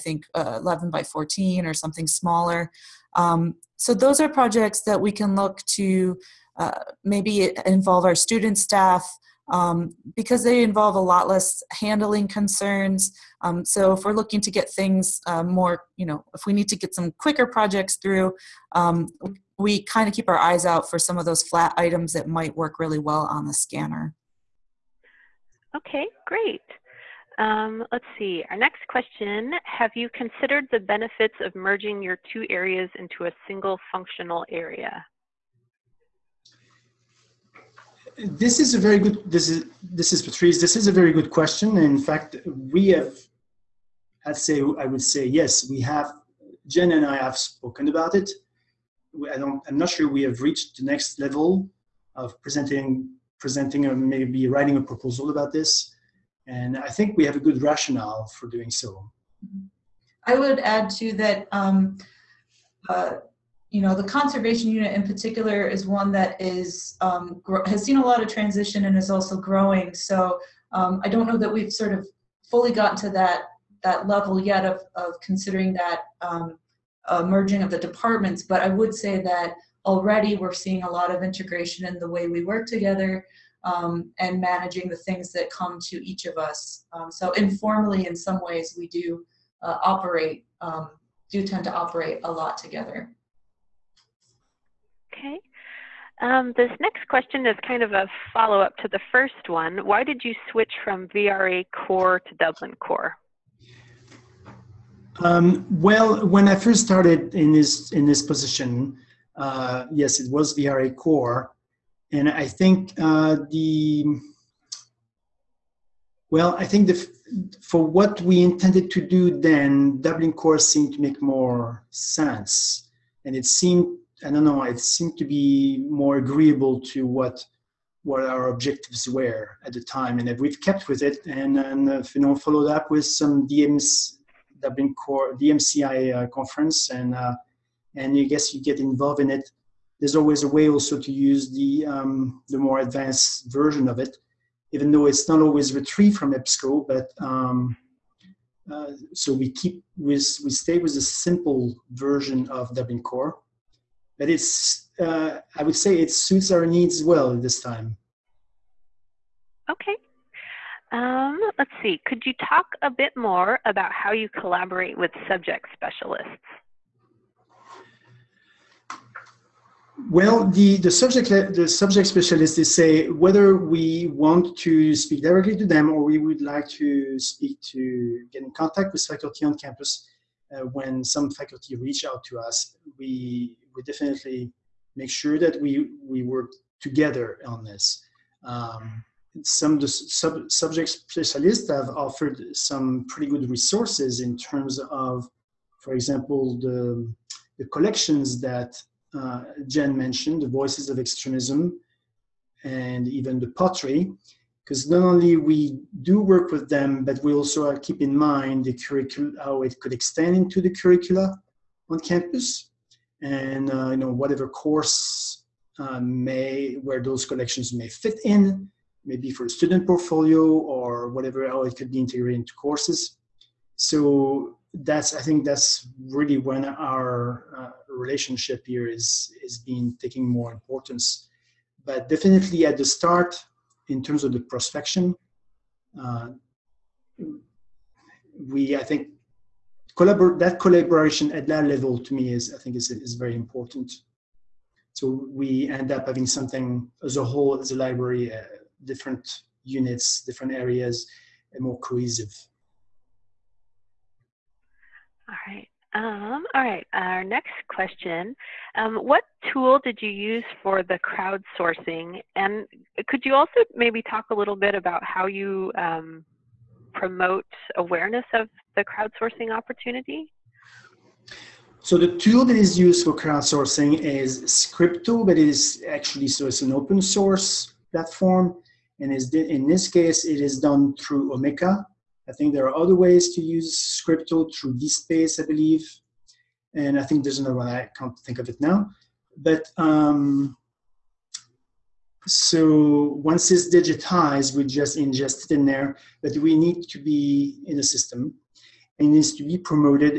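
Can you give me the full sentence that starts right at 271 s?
So the tool that is used for crowdsourcing is Scripto, but it is actually, so it's an open source platform.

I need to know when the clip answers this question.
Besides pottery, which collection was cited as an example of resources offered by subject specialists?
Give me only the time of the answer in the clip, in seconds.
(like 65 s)
200 s.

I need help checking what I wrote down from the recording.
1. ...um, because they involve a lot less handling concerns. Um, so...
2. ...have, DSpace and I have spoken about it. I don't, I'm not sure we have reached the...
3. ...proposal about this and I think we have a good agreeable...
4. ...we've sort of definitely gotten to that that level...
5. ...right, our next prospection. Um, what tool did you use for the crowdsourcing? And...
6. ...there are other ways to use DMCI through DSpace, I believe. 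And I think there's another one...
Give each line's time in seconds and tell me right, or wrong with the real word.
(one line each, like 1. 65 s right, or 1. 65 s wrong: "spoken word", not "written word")
1. 9 s right
2. 45 s wrong: "Jen", not "DSpace"
3. 54 s wrong: "rationale", not "agreeable"
4. 71 s wrong: "fully", not "definitely"
5. 256 s wrong: "question", not "prospection"
6. 282 s wrong: "Scripto", not "DMCI".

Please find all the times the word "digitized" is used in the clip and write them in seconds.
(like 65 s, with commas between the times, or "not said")
293 s.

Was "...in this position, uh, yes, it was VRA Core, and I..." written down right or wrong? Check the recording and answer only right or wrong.
right.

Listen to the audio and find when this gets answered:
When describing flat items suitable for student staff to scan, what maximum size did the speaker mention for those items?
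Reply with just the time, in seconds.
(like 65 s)
0 s.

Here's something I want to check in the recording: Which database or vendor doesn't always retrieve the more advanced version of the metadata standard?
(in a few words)
EBSCO.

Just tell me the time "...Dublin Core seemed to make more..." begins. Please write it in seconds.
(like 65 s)
119 s.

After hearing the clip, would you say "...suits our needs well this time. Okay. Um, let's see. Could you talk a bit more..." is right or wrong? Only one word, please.
right.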